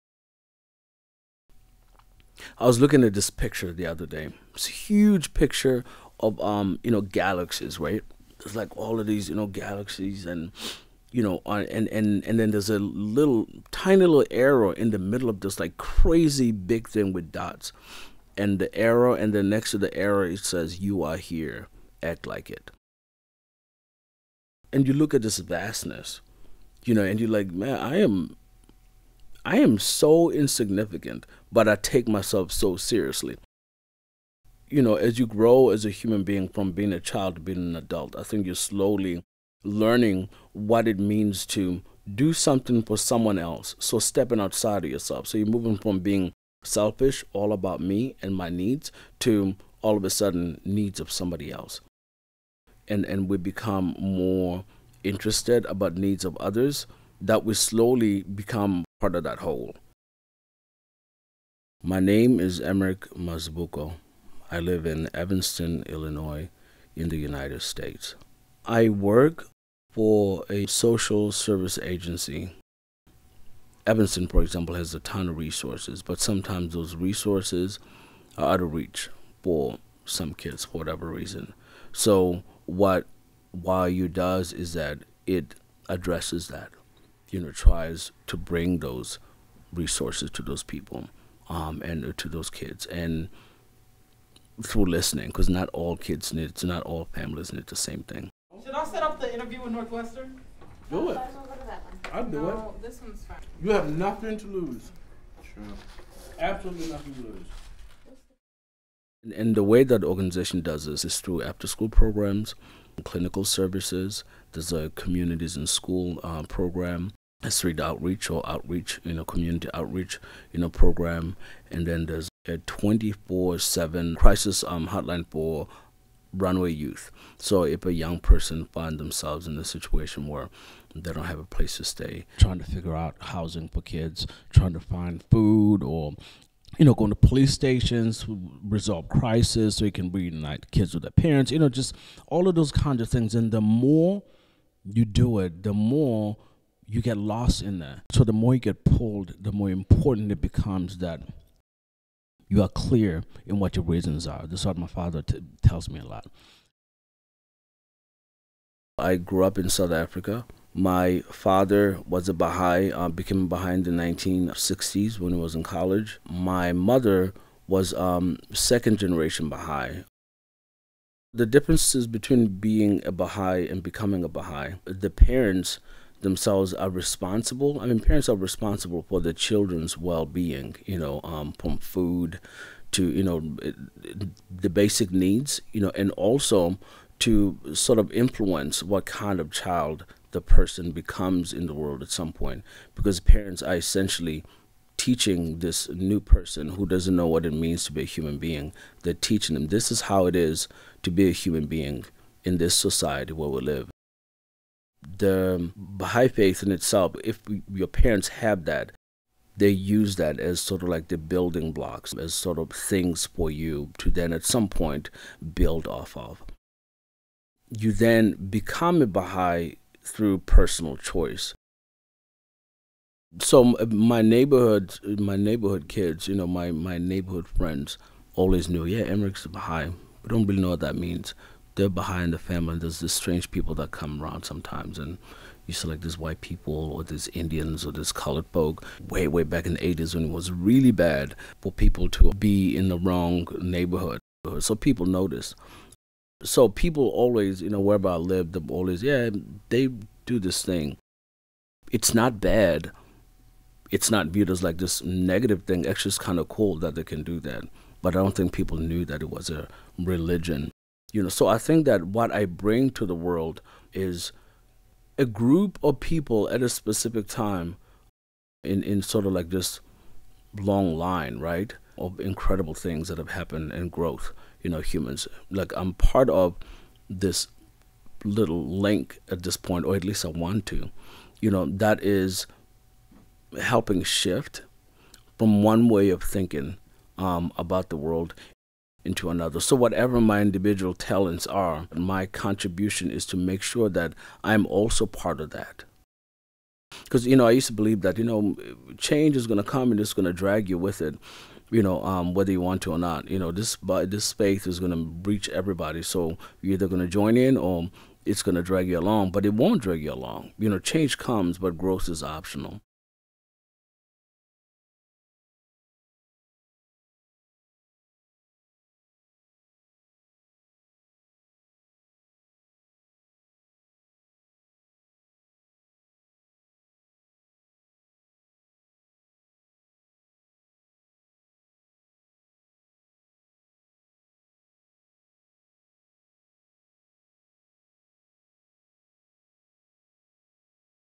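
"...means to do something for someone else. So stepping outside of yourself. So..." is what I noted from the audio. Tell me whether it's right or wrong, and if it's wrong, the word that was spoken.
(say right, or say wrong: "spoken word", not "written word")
right.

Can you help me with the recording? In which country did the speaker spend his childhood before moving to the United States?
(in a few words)
South Africa.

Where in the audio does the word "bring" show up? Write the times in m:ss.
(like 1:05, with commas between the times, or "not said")
1:28, 4:22.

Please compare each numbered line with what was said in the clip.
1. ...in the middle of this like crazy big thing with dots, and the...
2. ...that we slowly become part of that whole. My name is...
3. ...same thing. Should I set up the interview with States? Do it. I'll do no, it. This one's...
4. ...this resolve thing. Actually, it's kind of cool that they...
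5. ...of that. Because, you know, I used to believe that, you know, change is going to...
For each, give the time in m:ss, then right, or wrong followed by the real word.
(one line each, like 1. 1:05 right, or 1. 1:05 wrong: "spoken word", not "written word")
1. 0:14 right
2. 0:57 right
3. 1:37 wrong: "Northwestern", not "States"
4. 4:14 wrong: "negative", not "resolve"
5. 4:55 right.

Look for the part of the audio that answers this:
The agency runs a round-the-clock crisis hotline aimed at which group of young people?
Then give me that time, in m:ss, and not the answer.
2:06.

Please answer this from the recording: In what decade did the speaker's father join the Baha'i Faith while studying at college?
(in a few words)
1960s.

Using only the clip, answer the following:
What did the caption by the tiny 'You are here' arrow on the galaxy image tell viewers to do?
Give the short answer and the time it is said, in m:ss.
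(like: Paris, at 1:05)
Act like it, at 0:22.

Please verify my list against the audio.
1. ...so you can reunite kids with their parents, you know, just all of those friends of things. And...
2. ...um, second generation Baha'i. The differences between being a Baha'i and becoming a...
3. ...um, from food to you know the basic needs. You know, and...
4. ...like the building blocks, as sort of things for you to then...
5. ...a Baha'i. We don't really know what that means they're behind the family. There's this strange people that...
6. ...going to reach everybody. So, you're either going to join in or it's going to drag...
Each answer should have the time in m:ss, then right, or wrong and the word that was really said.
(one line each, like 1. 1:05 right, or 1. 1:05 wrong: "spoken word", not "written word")
1. 2:19 wrong: "kinds", not "friends"
2. 2:47 right
3. 3:01 right
4. 3:30 right
5. 3:49 right
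6. 5:04 right.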